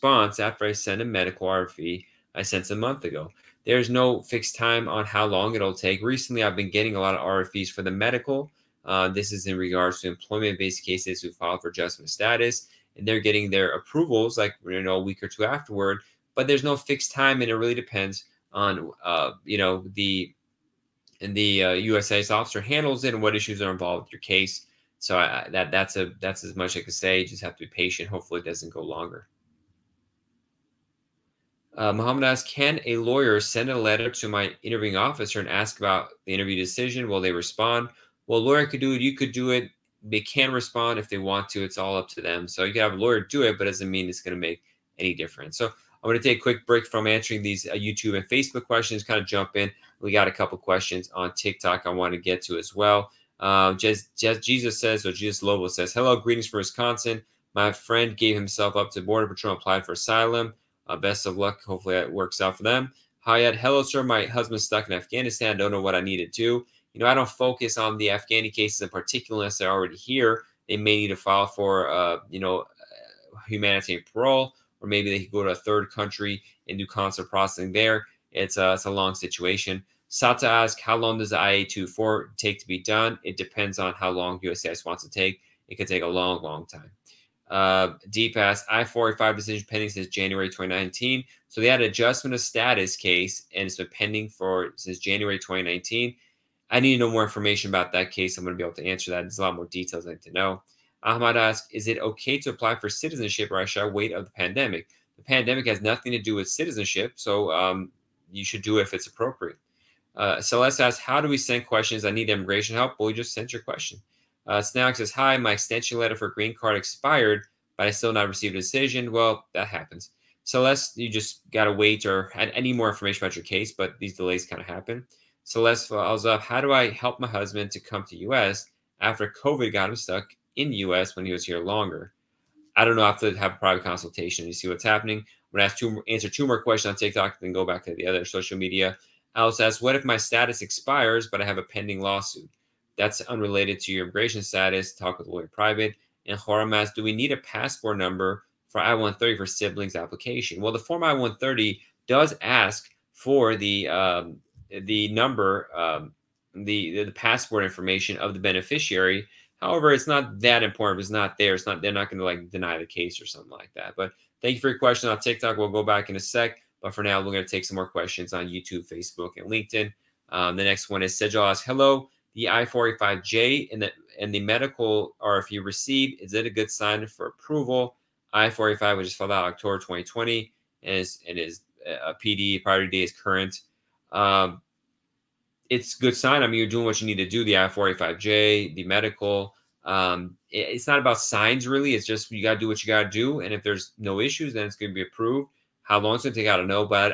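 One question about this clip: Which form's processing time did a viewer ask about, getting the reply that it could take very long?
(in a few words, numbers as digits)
I-824.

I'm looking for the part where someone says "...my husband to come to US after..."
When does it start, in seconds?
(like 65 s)
127 s.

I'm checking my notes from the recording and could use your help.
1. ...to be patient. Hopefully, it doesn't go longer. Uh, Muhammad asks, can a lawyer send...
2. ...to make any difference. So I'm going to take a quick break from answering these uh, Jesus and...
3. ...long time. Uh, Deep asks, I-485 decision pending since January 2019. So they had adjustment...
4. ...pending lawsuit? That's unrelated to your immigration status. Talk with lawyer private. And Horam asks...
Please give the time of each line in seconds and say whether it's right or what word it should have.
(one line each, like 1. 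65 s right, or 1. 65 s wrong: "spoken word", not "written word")
1. 27 s right
2. 44 s wrong: "YouTube", not "Jesus"
3. 86 s right
4. 141 s right.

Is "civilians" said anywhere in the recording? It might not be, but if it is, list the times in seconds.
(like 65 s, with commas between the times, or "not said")
not said.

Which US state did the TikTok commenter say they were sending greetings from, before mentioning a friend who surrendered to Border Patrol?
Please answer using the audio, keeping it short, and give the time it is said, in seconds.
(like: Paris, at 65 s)
Wisconsin, at 56 s.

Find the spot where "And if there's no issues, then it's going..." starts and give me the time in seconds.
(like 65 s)
193 s.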